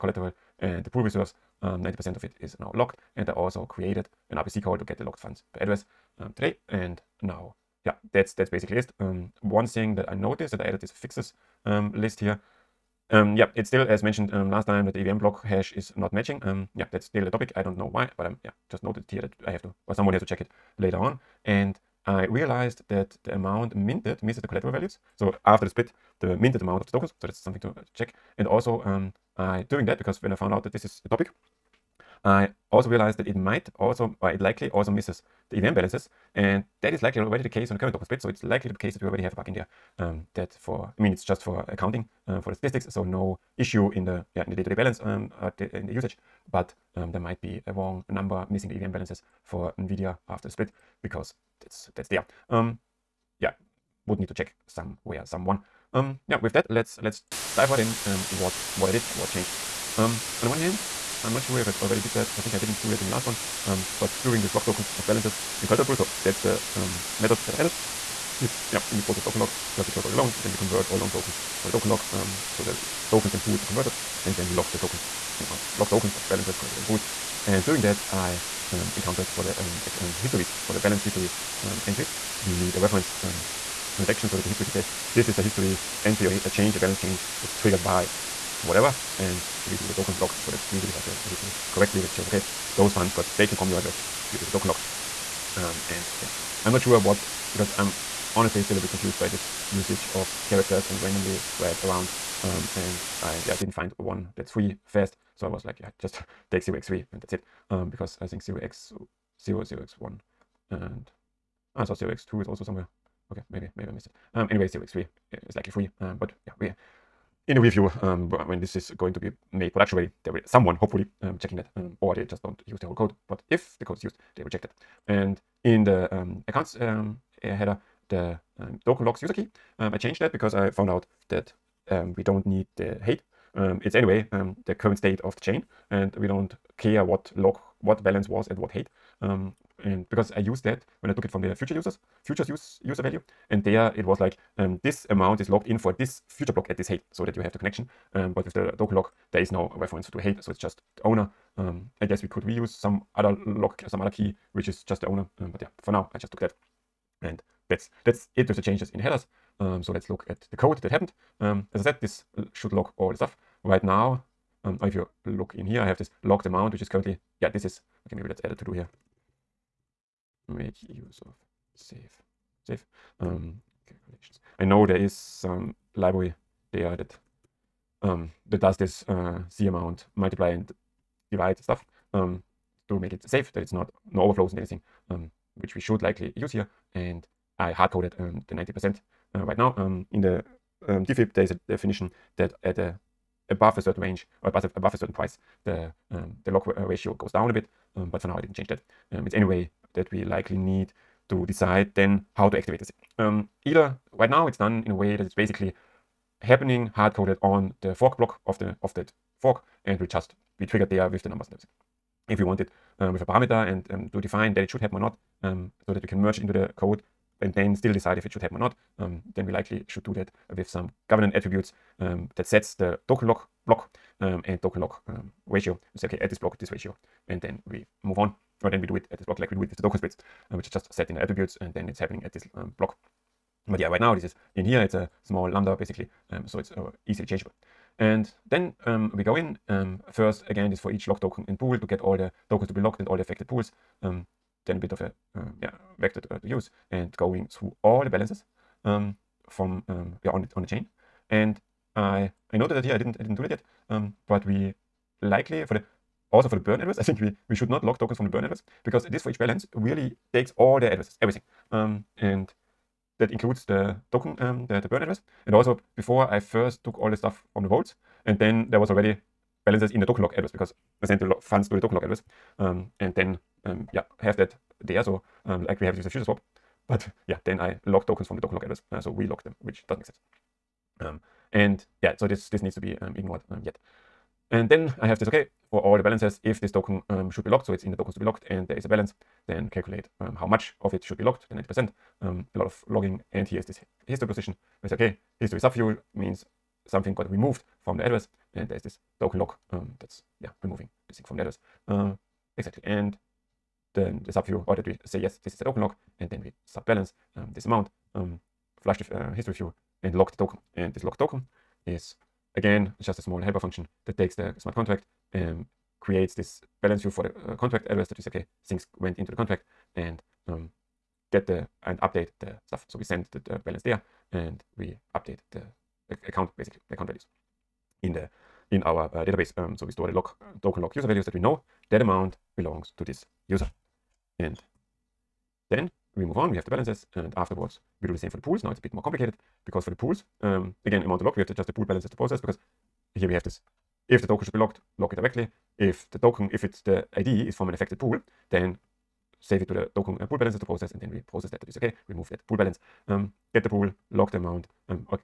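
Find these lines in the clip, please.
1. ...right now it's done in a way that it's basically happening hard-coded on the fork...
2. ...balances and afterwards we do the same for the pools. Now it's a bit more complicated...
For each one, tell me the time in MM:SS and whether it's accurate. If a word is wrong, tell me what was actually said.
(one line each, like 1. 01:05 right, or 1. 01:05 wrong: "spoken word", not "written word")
1. 03:24 right
2. 05:36 right.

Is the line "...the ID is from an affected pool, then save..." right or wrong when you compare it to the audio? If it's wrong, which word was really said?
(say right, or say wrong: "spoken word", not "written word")
right.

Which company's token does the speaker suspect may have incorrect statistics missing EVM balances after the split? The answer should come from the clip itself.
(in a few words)
NVIDIA.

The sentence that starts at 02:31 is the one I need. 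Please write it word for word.
Um, I guess we could reuse some other lock, some other key, which is just the owner.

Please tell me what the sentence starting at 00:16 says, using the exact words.
Um, yeah, that's still a topic.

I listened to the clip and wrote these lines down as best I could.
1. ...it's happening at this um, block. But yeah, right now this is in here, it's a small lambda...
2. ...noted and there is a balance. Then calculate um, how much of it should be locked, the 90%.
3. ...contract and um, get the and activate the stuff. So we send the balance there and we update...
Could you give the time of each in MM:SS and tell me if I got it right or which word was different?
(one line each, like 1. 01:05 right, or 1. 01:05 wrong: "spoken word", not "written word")
1. 03:51 right
2. 04:48 wrong: "locked", not "noted"
3. 05:19 wrong: "update", not "activate".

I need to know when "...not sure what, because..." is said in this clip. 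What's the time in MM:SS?
01:36.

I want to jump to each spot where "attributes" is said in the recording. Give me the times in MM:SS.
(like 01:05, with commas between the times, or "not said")
03:41, 03:51.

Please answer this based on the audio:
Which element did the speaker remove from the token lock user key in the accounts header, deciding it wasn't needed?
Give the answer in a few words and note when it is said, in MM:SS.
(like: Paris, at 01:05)
the height, at 02:12.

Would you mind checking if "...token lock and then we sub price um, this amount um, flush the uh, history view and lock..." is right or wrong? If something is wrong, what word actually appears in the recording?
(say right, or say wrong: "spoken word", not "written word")
wrong: "balance", not "price".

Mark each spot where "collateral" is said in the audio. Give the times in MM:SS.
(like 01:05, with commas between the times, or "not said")
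00:24, 01:05, 01:16.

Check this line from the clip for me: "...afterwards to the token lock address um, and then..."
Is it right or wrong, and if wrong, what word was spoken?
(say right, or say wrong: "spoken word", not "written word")
wrong: "funds", not "afterwards".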